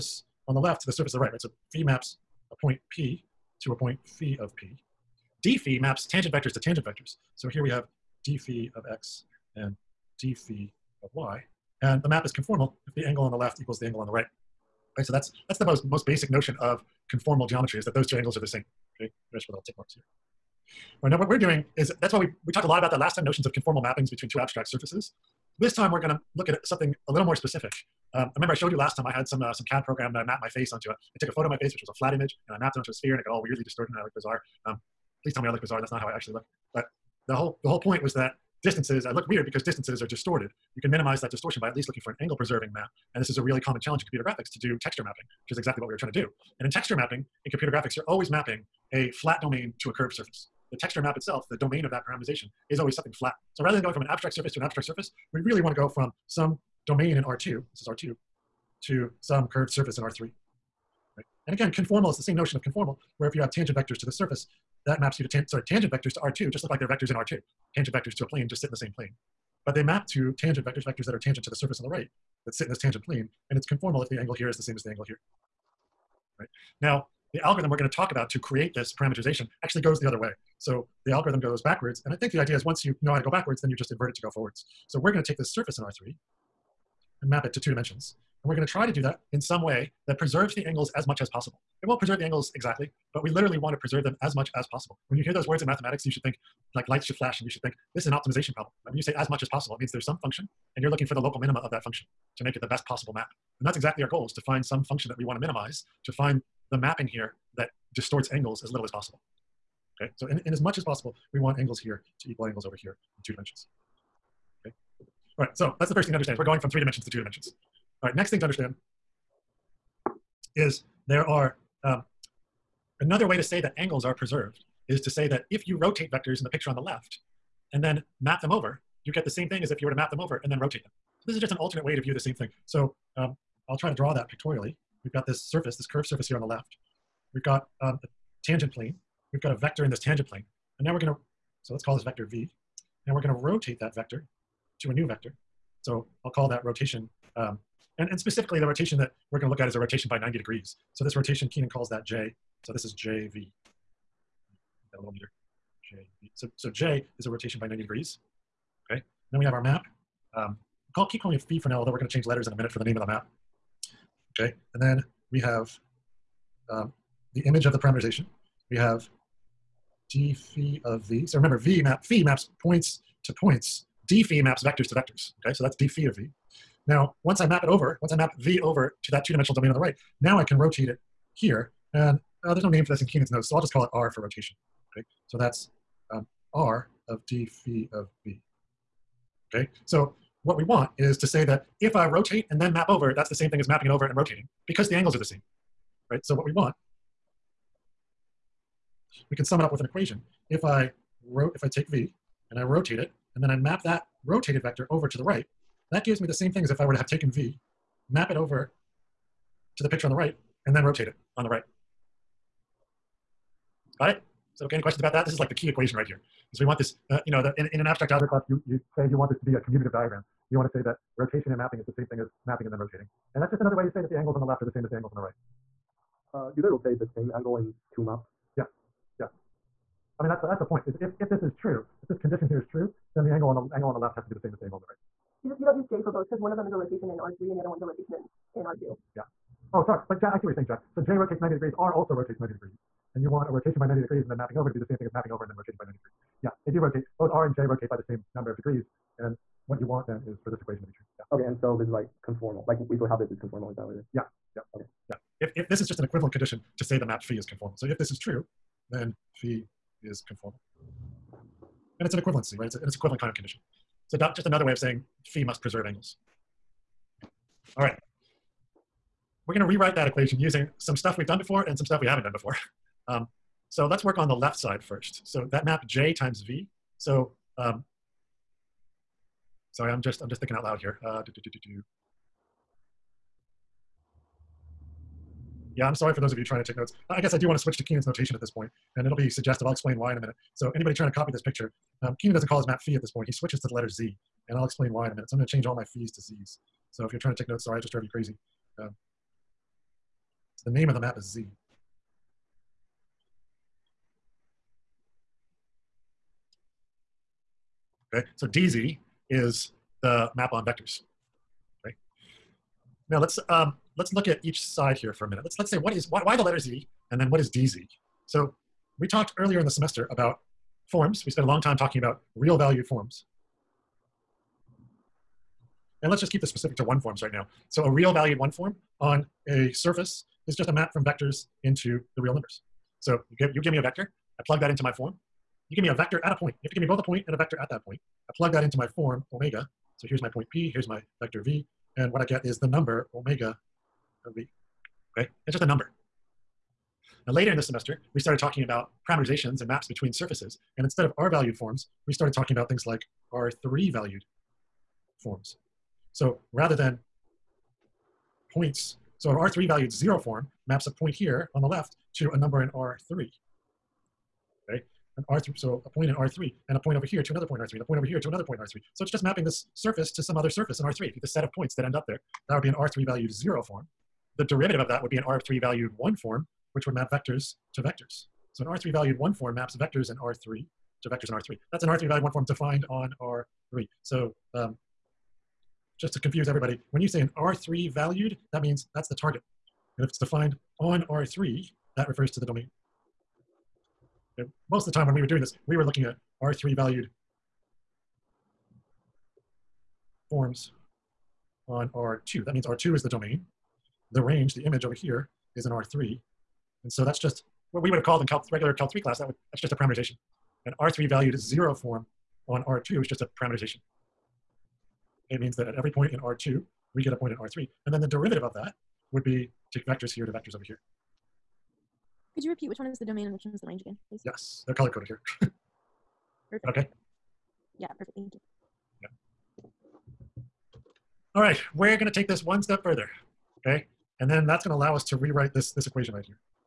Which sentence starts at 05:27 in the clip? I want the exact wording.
So a real valued one form on a surface is just a map from vectors into the real numbers.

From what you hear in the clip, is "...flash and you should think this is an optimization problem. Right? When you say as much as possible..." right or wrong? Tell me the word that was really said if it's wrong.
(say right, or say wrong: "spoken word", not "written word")
right.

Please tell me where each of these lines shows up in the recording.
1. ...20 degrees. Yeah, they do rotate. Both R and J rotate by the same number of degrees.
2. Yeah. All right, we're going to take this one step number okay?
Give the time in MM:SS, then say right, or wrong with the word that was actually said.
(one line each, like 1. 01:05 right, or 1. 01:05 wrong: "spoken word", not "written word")
1. 04:05 wrong: "90", not "20"
2. 07:09 wrong: "further", not "number".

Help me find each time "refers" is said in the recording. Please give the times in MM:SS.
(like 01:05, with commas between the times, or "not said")
06:32.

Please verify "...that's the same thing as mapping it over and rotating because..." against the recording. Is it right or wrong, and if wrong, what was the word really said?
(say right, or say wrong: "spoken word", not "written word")
right.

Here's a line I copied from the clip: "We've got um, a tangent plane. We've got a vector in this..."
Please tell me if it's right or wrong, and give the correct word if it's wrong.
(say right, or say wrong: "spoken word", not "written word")
right.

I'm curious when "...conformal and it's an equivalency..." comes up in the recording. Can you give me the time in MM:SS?
04:20.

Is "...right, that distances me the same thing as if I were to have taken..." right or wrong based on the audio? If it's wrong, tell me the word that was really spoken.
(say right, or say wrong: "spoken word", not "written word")
wrong: "gives", not "distances".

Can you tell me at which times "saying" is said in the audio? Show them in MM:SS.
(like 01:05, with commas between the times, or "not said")
04:00, 04:24.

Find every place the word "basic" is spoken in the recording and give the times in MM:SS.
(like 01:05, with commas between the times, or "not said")
00:16.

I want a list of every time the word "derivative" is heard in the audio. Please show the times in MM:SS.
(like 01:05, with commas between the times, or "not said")
06:14, 06:58.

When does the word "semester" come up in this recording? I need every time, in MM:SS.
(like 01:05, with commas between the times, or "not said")
05:19, 05:47.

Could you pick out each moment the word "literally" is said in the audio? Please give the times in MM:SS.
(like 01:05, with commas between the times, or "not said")
01:33.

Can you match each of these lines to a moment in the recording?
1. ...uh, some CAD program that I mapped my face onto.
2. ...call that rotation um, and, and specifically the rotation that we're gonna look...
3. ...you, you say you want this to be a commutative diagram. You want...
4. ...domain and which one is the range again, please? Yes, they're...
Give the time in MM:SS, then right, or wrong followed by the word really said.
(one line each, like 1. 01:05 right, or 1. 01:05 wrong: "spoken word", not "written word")
1. 00:29 right
2. 02:26 right
3. 03:38 right
4. 07:03 right.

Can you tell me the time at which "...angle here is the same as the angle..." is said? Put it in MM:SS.
01:14.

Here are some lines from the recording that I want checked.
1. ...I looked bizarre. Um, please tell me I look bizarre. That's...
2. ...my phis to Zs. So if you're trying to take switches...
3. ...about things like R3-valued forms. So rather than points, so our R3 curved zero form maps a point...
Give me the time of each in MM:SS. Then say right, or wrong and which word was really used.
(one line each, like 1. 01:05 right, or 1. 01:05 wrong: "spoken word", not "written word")
1. 00:33 right
2. 04:55 wrong: "notes", not "switches"
3. 05:52 wrong: "valued", not "curved".